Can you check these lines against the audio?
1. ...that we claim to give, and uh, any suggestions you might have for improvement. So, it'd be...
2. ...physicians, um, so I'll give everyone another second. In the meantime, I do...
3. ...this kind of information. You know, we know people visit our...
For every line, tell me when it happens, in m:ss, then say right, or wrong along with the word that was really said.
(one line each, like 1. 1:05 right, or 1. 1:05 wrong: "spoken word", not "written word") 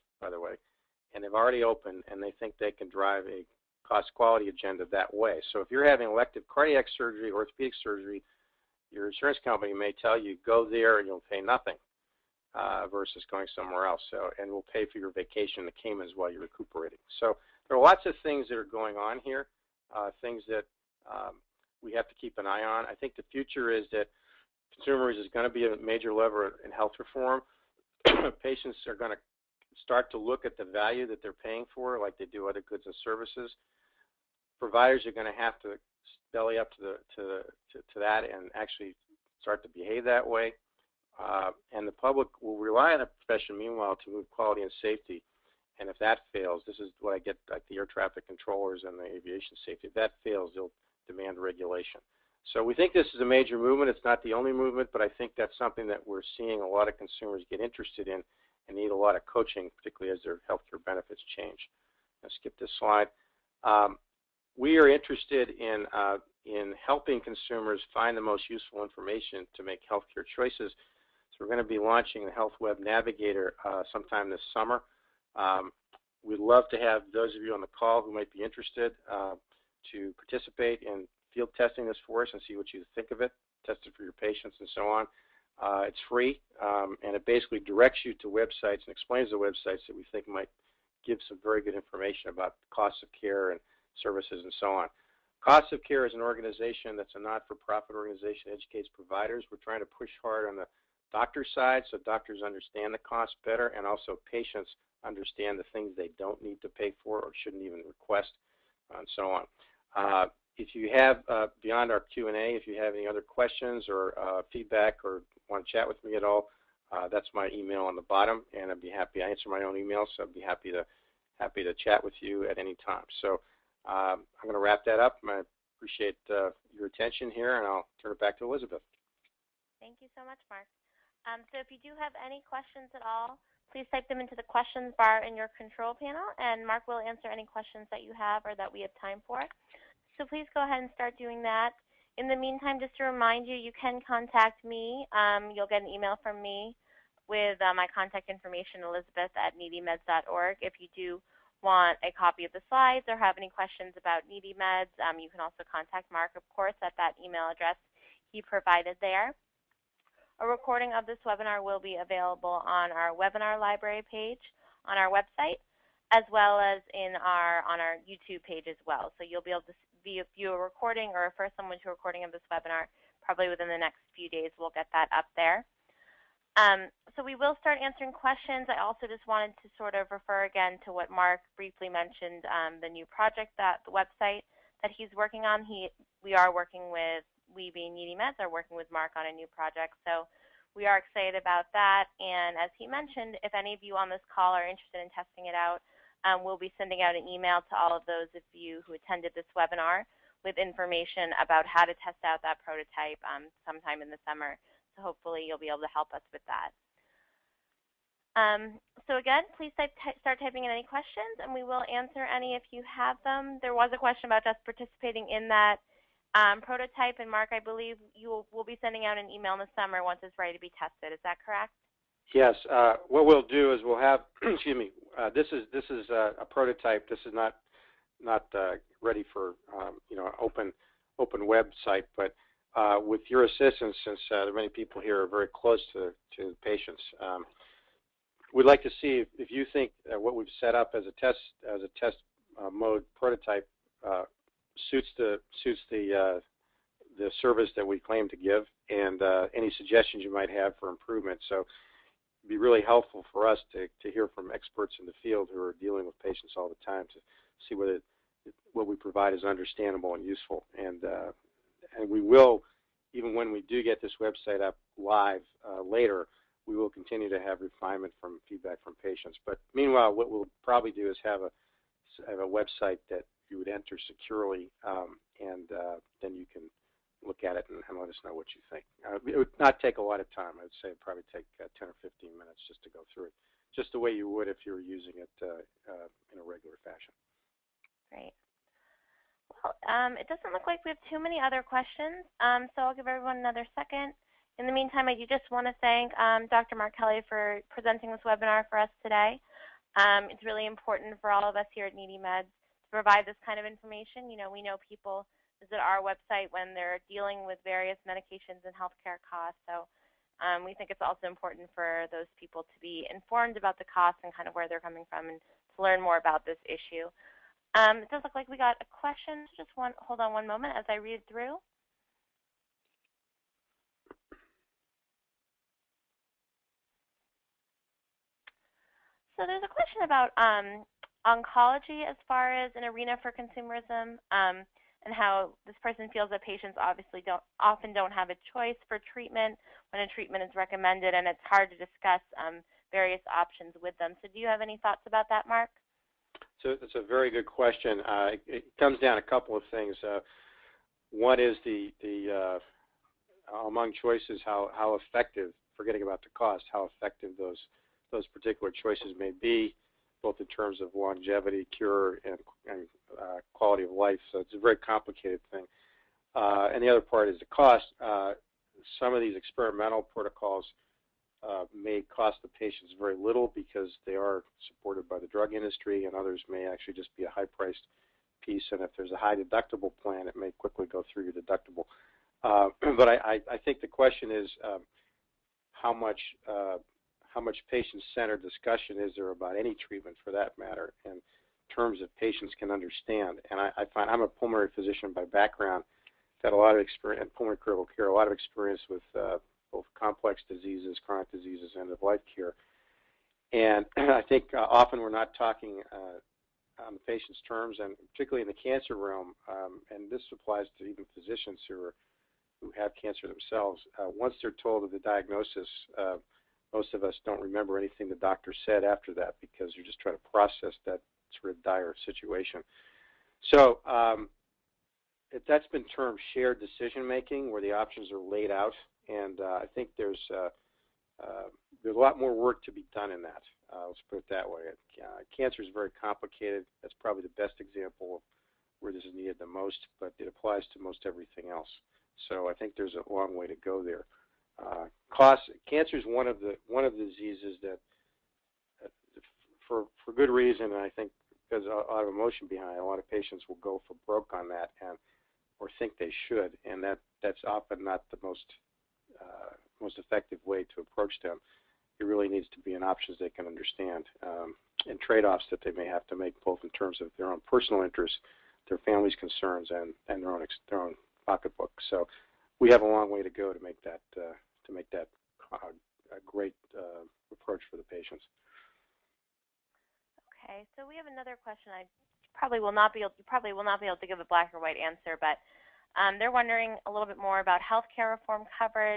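1. 4:07 right
2. 4:51 wrong: "questions", not "physicians"
3. 5:03 right.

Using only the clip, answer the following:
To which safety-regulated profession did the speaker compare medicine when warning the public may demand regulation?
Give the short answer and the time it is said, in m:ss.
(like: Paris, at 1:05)
air traffic controllers, at 0:47.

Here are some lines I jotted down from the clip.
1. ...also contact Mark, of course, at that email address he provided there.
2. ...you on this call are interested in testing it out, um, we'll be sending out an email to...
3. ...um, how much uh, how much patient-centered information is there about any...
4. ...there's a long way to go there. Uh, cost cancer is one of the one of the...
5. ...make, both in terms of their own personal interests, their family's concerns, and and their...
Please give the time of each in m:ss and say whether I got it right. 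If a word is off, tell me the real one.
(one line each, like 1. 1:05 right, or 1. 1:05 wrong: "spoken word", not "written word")
1. 2:35 right
2. 3:13 right
3. 6:24 wrong: "discussion", not "information"
4. 7:22 right
5. 7:46 right.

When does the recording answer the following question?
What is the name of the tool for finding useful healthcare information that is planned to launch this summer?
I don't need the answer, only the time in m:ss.
1:12.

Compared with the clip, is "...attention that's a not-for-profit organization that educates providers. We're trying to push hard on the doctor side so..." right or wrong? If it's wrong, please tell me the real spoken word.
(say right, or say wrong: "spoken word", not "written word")
wrong: "organization", not "attention".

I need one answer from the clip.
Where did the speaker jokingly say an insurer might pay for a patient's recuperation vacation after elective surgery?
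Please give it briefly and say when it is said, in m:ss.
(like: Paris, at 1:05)
the Caymans, at 0:15.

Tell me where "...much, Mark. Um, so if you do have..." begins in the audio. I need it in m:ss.
2:10.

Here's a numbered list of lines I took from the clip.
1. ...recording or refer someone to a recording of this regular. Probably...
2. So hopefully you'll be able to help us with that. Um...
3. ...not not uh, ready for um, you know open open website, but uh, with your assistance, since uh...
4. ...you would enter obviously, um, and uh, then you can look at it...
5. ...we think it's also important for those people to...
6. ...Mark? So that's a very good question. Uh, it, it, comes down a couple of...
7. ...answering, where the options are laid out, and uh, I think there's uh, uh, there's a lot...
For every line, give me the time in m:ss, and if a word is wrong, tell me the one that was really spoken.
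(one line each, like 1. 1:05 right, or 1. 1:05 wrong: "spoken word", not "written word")
1. 2:50 wrong: "webinar", not "regular"
2. 3:24 right
3. 3:47 right
4. 4:33 wrong: "securely", not "obviously"
5. 5:10 right
6. 5:45 right
7. 7:07 wrong: "making", not "answering".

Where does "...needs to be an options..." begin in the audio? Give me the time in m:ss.
7:42.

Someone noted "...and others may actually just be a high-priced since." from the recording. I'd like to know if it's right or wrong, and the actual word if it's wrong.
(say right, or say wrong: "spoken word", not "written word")
wrong: "piece", not "since".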